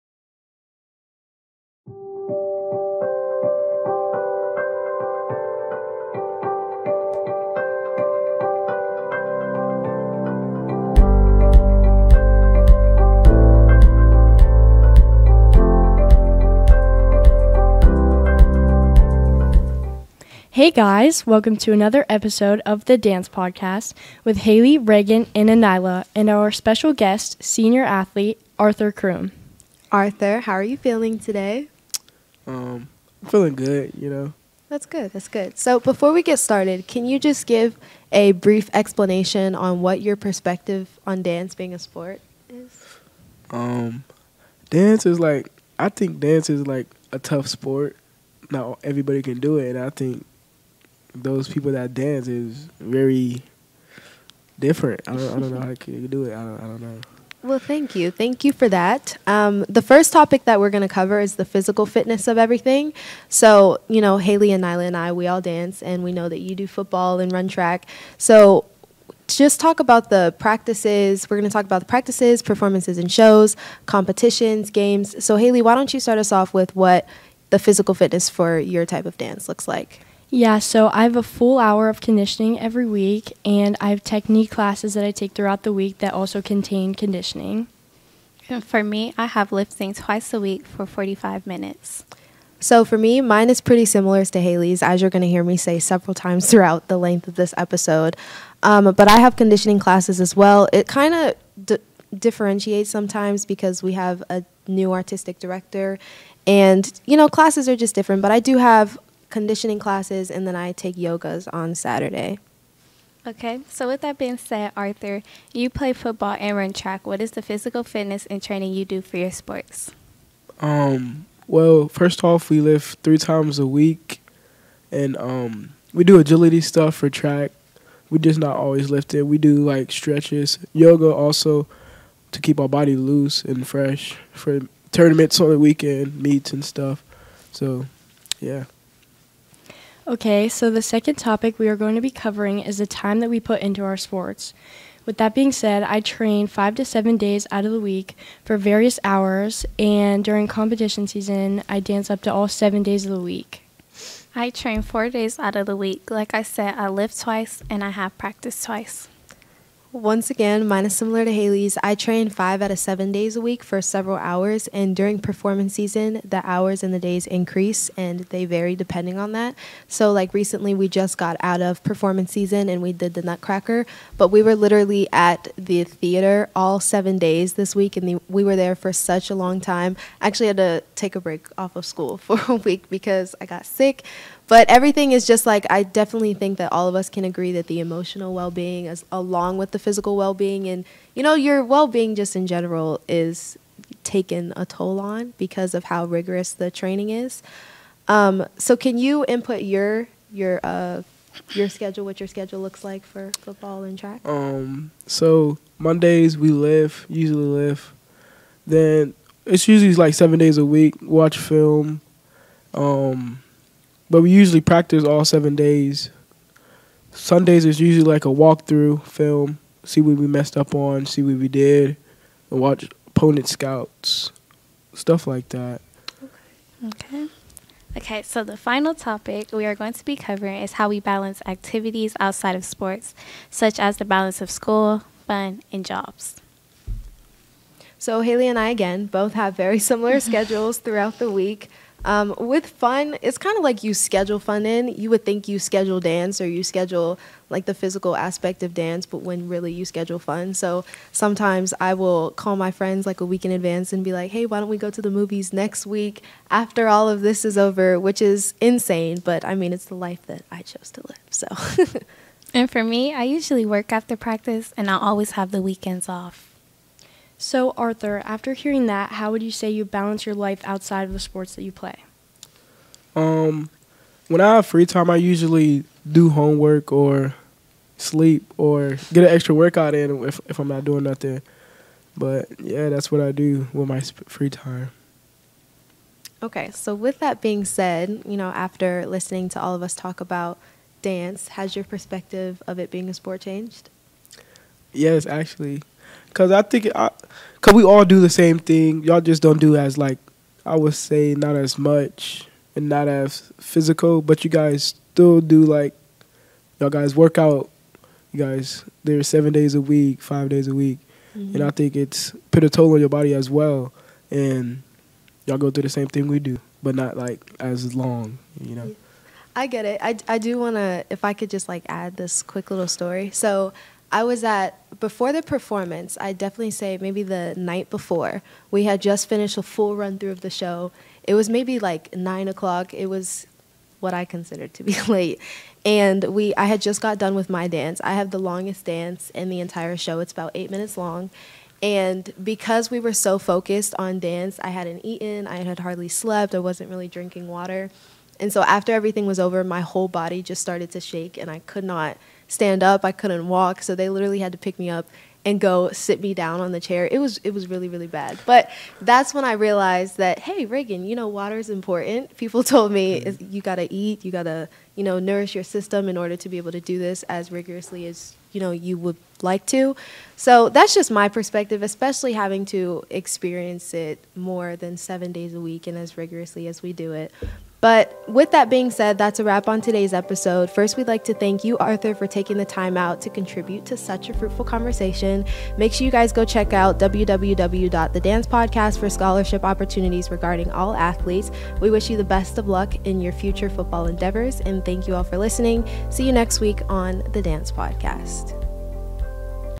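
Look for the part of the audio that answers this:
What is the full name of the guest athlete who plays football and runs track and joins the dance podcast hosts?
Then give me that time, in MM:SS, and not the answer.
00:28.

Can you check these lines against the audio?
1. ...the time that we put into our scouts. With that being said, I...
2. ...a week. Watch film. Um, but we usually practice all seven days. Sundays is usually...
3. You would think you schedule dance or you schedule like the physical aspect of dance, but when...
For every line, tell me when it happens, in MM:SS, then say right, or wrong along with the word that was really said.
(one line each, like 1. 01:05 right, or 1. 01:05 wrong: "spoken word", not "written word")
1. 02:22 wrong: "sports", not "scouts"
2. 03:30 right
3. 04:04 right.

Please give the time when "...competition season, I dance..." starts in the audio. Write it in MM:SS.
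02:30.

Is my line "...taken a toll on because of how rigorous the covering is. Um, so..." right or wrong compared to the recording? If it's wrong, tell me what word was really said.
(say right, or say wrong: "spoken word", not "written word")
wrong: "training", not "covering".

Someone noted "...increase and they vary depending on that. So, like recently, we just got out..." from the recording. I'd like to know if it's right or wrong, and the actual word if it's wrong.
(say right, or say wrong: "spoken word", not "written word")
right.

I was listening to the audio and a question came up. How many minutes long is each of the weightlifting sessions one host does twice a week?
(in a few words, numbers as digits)
45.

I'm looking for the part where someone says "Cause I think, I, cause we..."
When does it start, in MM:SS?
04:56.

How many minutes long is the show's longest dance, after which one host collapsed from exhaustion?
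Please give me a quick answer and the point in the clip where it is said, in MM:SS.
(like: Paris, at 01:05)
8, at 05:40.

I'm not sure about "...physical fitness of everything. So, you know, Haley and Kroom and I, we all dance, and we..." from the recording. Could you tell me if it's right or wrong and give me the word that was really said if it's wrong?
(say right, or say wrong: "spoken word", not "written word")
wrong: "Nyla", not "Kroom".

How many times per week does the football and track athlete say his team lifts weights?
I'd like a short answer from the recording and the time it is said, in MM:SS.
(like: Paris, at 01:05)
3, at 02:02.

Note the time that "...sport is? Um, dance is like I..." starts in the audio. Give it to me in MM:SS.
00:41.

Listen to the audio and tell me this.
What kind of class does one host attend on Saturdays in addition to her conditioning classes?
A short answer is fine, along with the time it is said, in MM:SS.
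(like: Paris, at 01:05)
yoga, at 01:50.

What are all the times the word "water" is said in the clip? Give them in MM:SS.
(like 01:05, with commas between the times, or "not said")
05:47, 06:01.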